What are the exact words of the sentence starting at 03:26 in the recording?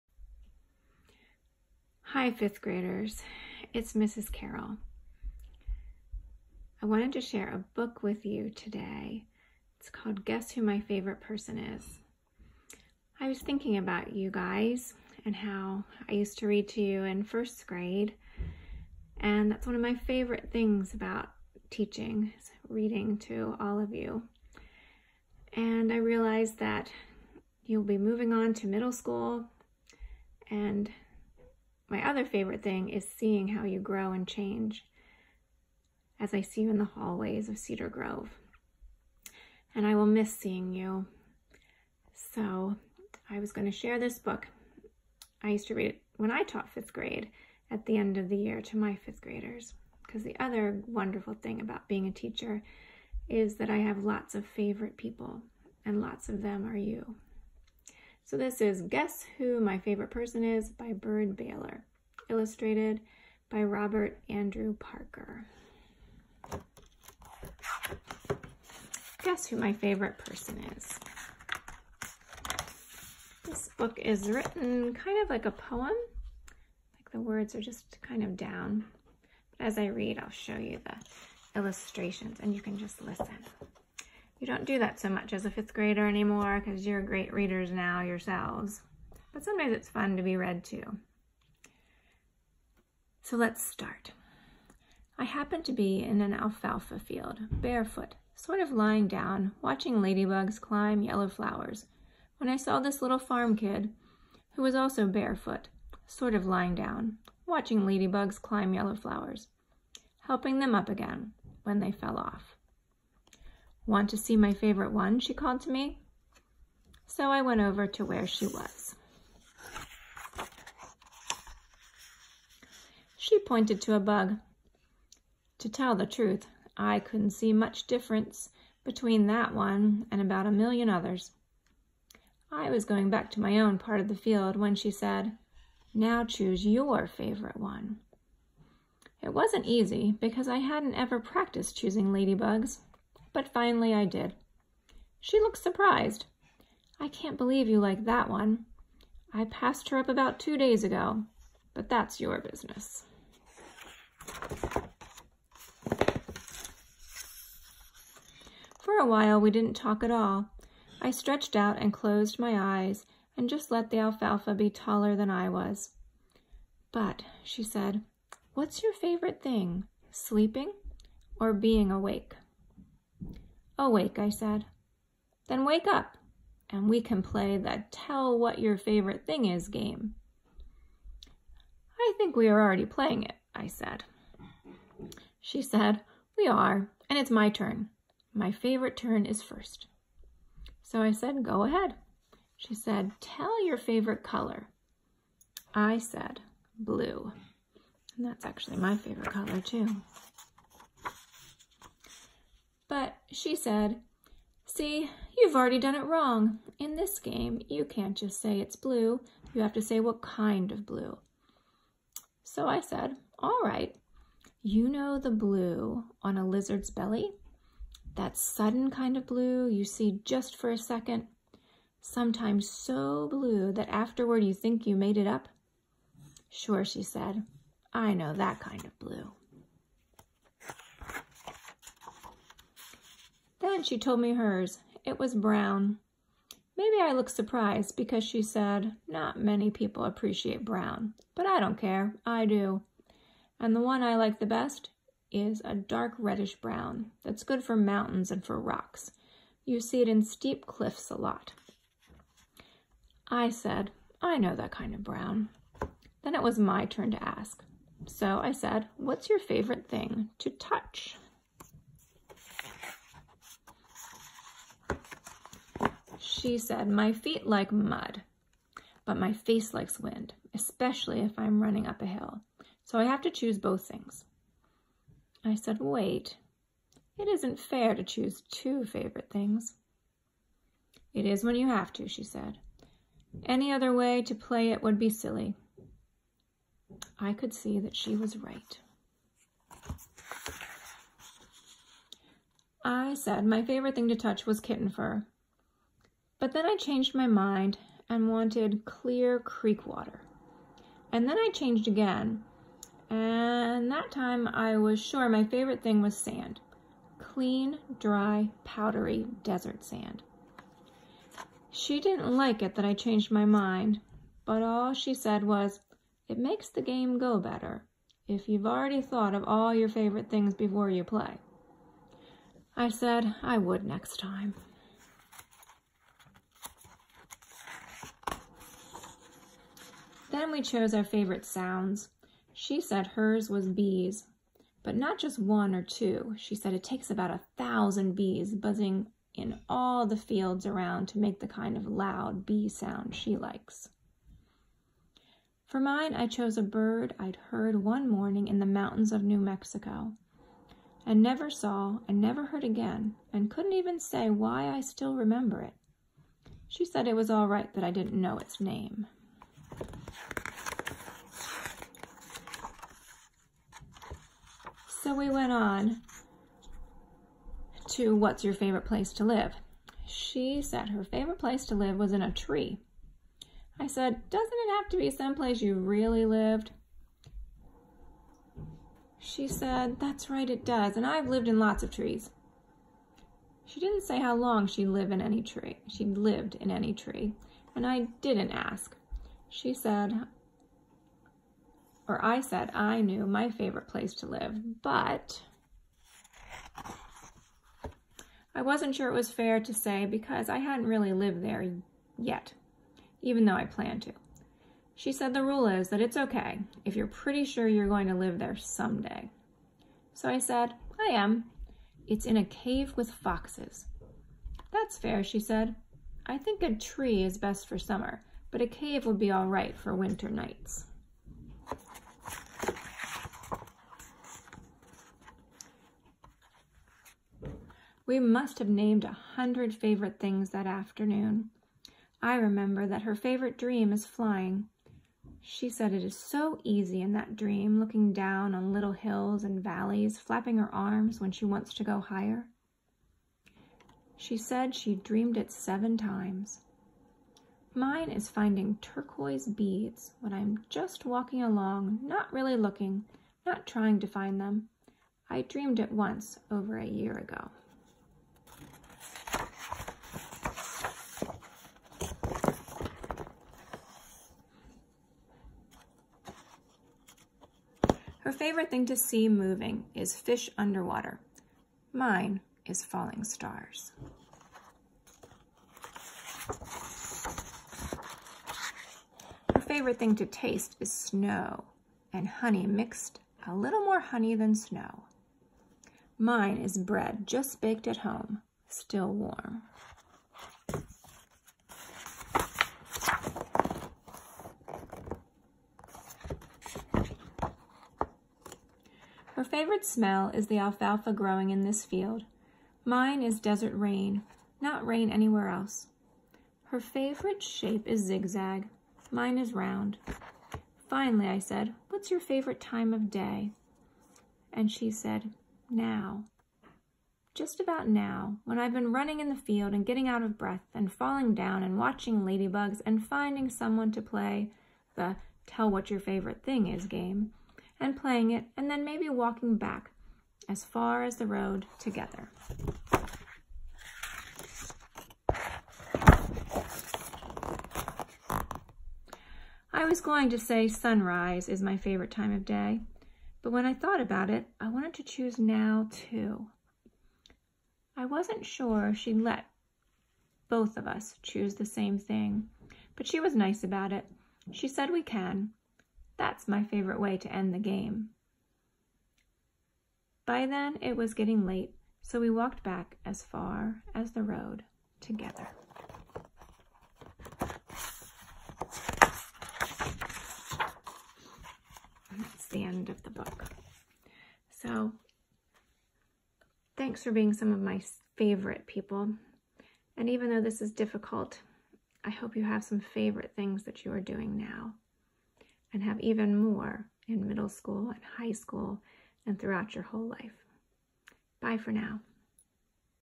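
In this game, you can't just say it's blue.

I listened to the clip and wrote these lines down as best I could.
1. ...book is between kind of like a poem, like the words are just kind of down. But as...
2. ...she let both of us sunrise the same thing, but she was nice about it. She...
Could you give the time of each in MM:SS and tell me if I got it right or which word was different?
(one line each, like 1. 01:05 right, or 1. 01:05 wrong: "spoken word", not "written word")
1. 01:13 wrong: "written", not "between"
2. 09:08 wrong: "choose", not "sunrise".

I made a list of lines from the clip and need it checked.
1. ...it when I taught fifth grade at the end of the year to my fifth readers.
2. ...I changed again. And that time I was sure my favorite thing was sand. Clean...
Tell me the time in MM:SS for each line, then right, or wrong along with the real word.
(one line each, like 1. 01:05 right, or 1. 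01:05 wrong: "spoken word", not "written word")
1. 00:45 wrong: "graders", not "readers"
2. 05:01 right.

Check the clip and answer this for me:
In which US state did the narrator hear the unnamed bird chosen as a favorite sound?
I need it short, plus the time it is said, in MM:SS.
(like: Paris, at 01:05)
New Mexico, at 05:49.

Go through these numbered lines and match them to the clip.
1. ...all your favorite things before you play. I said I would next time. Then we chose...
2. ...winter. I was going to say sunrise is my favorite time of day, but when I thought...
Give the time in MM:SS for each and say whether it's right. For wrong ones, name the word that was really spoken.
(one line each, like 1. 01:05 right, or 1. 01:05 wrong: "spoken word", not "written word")
1. 05:19 right
2. 08:51 wrong: "together", not "winter".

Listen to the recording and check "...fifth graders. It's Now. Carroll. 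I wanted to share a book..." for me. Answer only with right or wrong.
wrong.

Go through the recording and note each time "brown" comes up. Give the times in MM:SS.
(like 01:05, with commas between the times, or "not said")
03:55, 04:00, 04:06, 04:15.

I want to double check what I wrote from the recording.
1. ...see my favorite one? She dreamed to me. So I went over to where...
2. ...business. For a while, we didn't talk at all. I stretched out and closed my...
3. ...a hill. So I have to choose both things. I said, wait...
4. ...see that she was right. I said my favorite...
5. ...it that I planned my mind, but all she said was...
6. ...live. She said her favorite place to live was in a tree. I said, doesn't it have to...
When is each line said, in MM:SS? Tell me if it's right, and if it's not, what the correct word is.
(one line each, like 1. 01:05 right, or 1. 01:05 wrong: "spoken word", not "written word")
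1. 01:54 wrong: "called", not "dreamed"
2. 02:32 right
3. 04:32 right
4. 04:47 right
5. 05:12 wrong: "changed", not "planned"
6. 06:09 right.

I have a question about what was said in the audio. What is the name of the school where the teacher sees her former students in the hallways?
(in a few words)
Cedar Grove.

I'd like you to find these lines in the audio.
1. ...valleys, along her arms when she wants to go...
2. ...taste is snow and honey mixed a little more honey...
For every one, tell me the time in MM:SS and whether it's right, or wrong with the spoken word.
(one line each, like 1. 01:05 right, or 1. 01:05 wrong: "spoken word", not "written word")
1. 07:19 wrong: "flapping", not "along"
2. 08:00 right.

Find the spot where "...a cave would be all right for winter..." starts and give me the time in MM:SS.
06:58.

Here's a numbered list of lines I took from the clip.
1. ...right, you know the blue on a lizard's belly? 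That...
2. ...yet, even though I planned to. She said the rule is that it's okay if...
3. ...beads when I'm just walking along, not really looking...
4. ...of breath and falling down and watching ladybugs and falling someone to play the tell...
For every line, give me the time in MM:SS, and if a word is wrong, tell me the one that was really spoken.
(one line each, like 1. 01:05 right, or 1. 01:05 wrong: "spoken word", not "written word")
1. 03:33 right
2. 06:42 right
3. 07:29 right
4. 08:40 wrong: "finding", not "falling".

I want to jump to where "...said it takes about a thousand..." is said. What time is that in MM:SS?
05:36.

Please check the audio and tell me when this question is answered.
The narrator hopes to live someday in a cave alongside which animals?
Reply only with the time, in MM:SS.
06:53.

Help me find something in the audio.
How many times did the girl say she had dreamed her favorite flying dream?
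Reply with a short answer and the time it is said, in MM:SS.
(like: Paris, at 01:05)
7, at 07:25.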